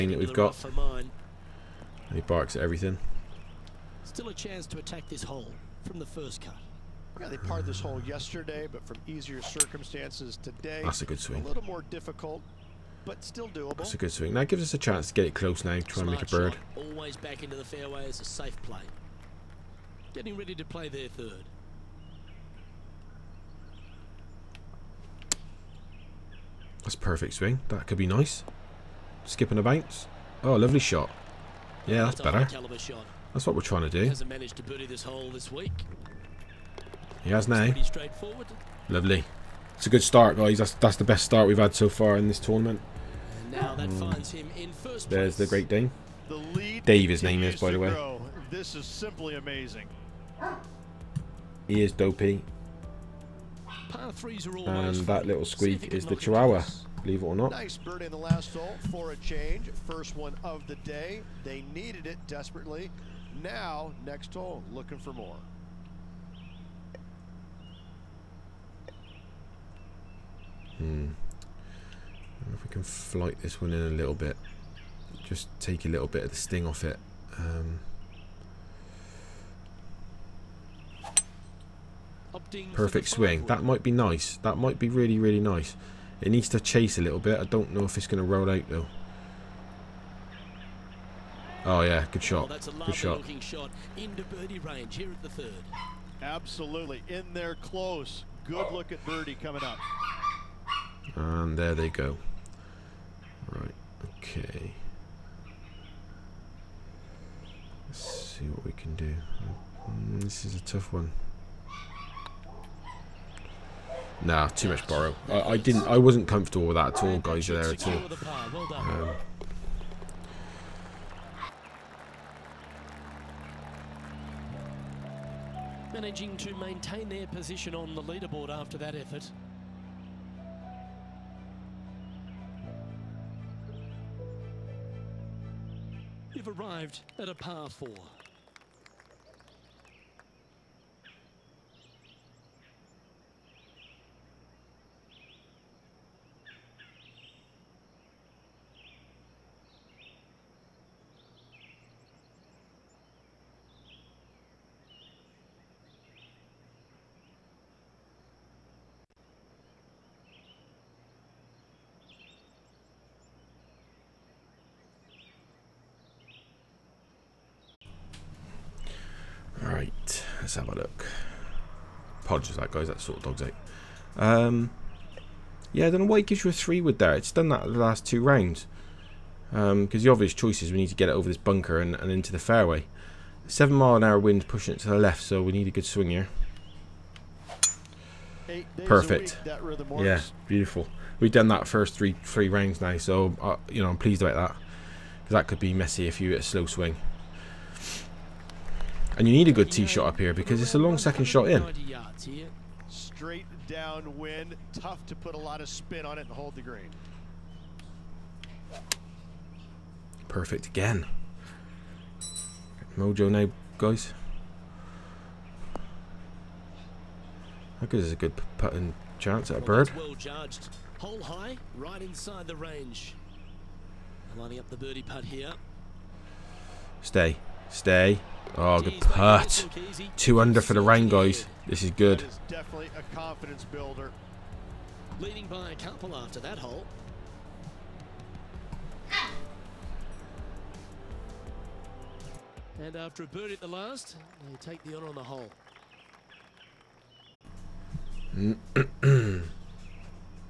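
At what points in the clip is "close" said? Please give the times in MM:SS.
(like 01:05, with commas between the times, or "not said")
00:15, 01:37.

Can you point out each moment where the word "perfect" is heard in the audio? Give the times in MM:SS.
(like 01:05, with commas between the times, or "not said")
00:26, 01:22, 03:08, 03:30.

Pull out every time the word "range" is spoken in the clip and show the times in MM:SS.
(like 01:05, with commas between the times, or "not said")
01:34, 03:42.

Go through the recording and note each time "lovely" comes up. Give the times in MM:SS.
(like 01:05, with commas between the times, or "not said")
00:30, 00:38.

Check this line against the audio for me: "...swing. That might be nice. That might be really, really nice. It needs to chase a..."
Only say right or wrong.
right.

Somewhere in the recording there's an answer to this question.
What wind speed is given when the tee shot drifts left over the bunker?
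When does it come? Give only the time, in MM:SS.
03:03.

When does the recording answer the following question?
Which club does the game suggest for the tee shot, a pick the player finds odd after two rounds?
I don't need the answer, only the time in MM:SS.
02:56.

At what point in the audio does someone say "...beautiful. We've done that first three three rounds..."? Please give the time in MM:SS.
03:10.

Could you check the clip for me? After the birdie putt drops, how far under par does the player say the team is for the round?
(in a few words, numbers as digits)
2 under.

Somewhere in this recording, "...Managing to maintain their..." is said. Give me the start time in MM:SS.
02:05.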